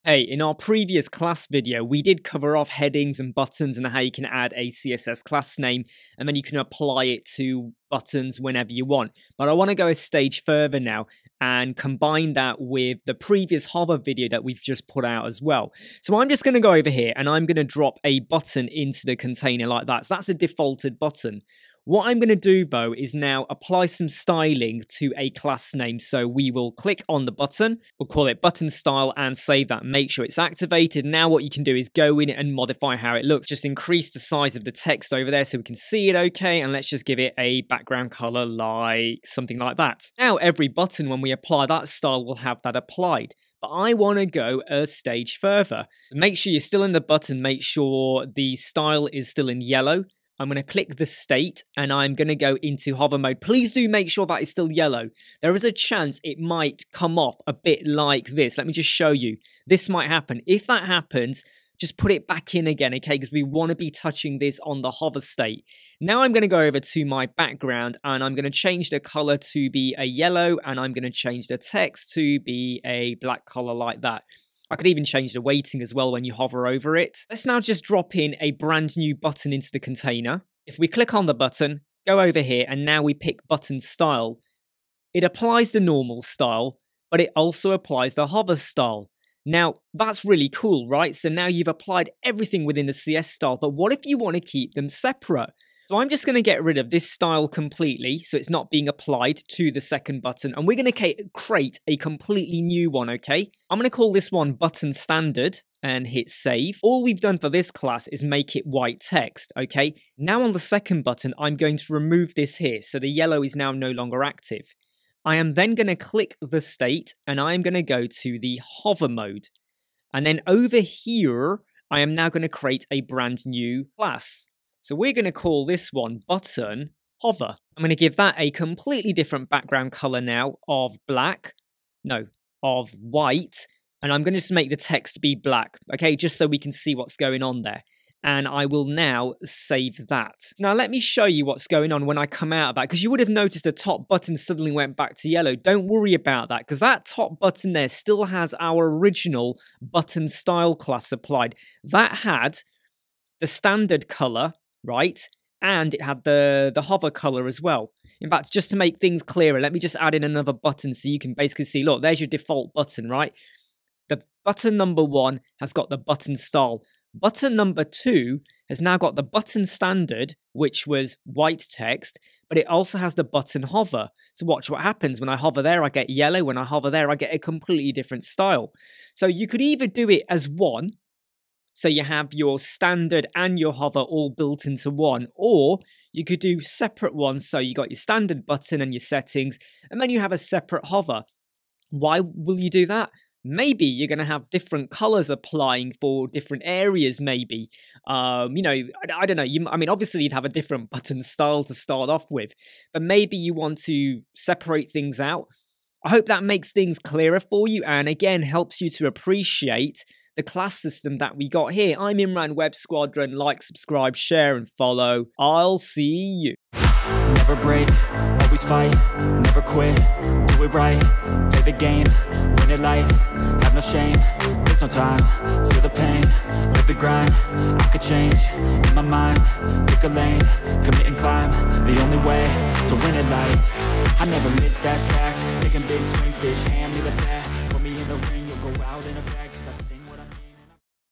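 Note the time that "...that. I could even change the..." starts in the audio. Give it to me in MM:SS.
01:14.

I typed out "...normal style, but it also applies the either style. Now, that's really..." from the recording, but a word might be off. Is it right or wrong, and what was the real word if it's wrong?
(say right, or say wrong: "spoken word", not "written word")
wrong: "hover", not "either".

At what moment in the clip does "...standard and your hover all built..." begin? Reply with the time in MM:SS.
03:02.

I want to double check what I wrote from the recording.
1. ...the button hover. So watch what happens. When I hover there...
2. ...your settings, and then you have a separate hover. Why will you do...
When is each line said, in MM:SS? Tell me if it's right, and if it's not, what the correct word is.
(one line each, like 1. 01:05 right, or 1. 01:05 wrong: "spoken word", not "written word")
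1. 02:53 right
2. 03:08 right.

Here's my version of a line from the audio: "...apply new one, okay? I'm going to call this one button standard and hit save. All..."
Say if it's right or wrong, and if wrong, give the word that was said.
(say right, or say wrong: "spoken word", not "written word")
wrong: "completely", not "apply".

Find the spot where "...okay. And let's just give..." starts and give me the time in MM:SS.
00:36.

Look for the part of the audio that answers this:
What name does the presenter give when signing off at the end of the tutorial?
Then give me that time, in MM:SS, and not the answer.
03:32.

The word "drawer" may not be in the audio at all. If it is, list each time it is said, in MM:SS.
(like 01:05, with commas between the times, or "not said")
not said.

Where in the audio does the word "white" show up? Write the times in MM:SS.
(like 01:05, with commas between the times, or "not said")
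01:48, 02:12, 02:51.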